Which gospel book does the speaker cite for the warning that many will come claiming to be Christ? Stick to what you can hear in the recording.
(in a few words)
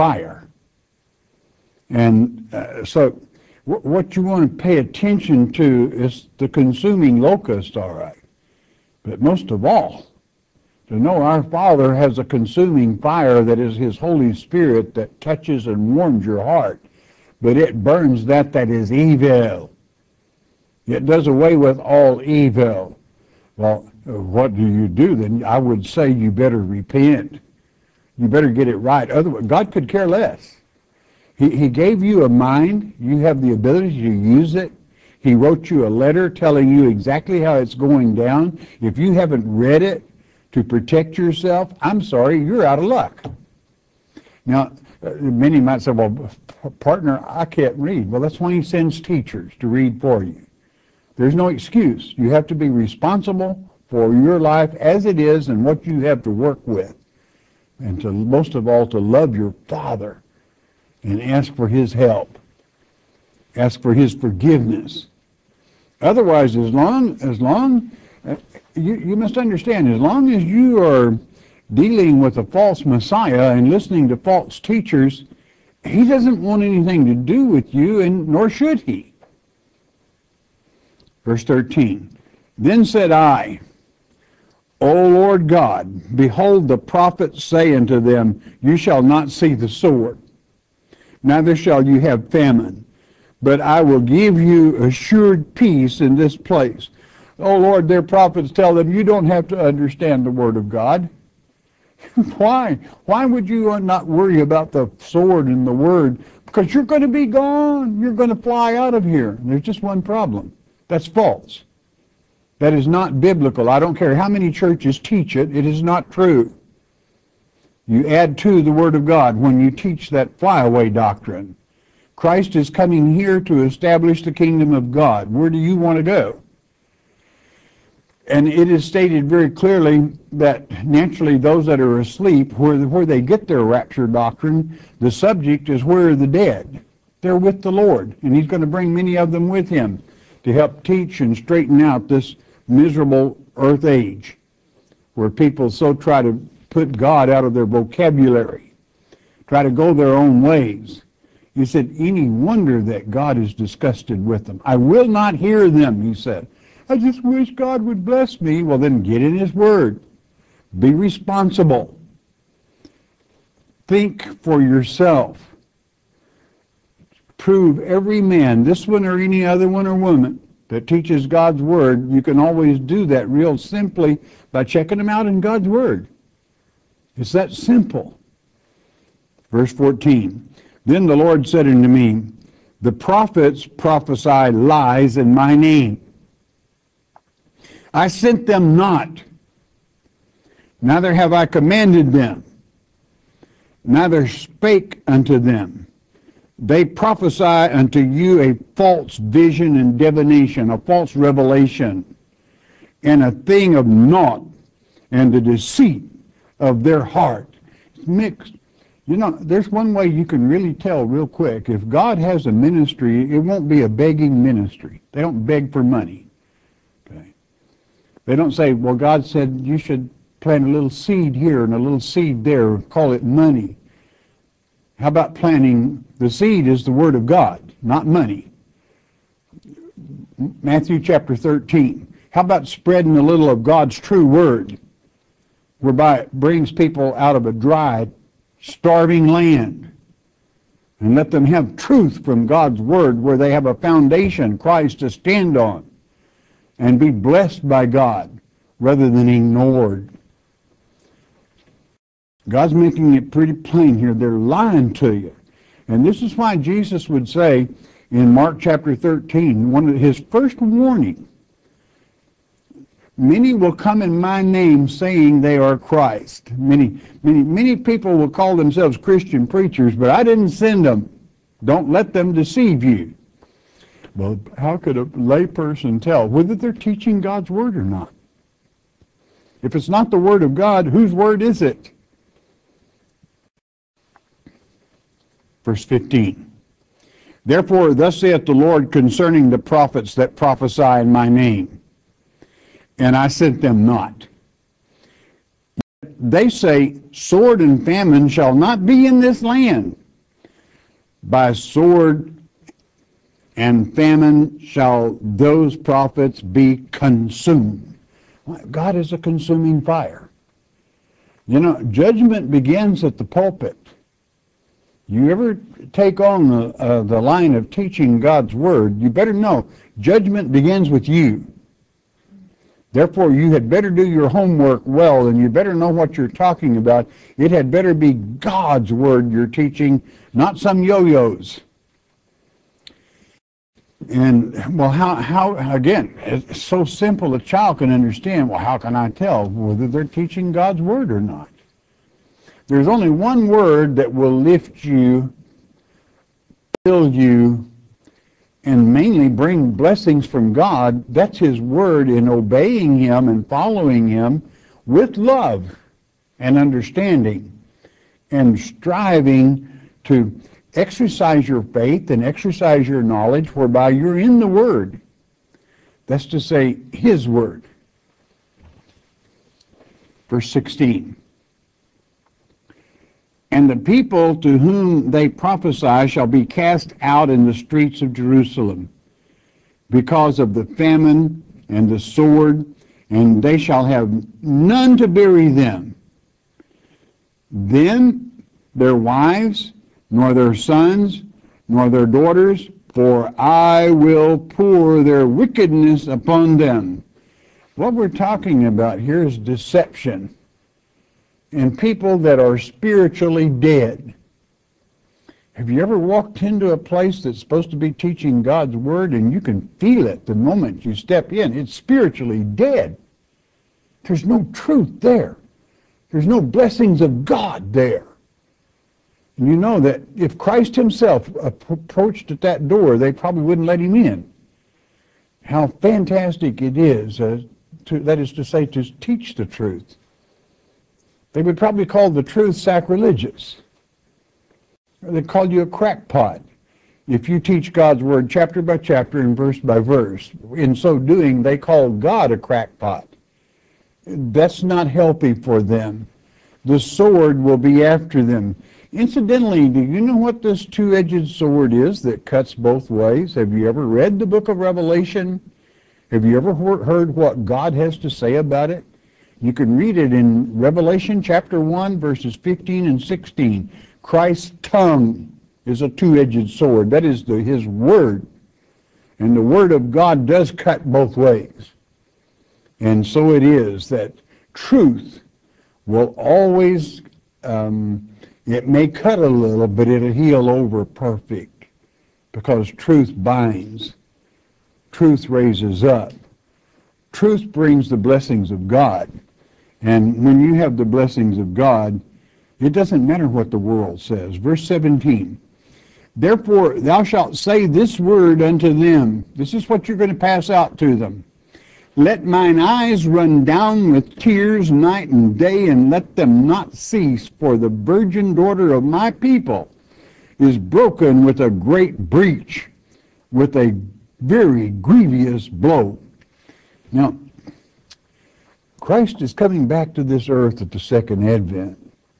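Mark.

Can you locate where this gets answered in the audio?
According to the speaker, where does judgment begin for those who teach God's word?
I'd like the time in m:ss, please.
5:13.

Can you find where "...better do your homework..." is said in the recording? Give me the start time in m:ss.
5:23.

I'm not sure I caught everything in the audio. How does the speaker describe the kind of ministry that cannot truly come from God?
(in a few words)
A begging ministry.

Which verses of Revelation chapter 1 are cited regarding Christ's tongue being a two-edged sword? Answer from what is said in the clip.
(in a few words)
15 and 16.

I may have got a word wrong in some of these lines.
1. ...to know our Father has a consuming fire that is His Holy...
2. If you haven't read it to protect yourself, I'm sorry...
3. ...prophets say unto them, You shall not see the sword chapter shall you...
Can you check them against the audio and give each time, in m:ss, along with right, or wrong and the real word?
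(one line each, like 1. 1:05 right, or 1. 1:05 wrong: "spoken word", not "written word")
1. 0:10 right
2. 0:38 right
3. 1:26 wrong: "neither", not "chapter".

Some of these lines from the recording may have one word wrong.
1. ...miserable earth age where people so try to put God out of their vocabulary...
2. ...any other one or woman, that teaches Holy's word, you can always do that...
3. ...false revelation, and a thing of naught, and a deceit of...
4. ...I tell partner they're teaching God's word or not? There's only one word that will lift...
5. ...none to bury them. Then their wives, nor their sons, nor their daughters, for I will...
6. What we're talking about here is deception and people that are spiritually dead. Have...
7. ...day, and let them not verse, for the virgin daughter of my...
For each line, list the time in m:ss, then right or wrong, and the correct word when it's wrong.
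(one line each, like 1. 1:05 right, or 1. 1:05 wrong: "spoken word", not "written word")
1. 2:22 right
2. 2:49 wrong: "God", not "Holy"
3. 3:20 right
4. 5:38 wrong: "whether", not "partner"
5. 6:24 right
6. 6:37 right
7. 8:25 wrong: "cease", not "verse".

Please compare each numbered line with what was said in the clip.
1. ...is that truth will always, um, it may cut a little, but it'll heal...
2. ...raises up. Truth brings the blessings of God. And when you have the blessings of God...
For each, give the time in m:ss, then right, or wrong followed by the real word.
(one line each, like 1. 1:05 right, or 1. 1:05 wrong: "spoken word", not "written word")
1. 7:53 right
2. 8:05 right.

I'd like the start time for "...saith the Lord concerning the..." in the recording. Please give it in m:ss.
4:48.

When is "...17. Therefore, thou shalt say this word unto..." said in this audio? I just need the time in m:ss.
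8:14.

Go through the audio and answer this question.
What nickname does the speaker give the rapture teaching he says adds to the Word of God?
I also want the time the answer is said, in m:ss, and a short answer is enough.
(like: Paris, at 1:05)
Flyaway doctrine, at 2:00.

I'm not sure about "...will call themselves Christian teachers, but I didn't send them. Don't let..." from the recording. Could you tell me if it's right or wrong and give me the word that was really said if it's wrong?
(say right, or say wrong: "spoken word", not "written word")
wrong: "preachers", not "teachers".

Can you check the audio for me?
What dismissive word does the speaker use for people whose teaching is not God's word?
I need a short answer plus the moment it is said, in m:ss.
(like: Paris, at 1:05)
yo-yos, at 5:30.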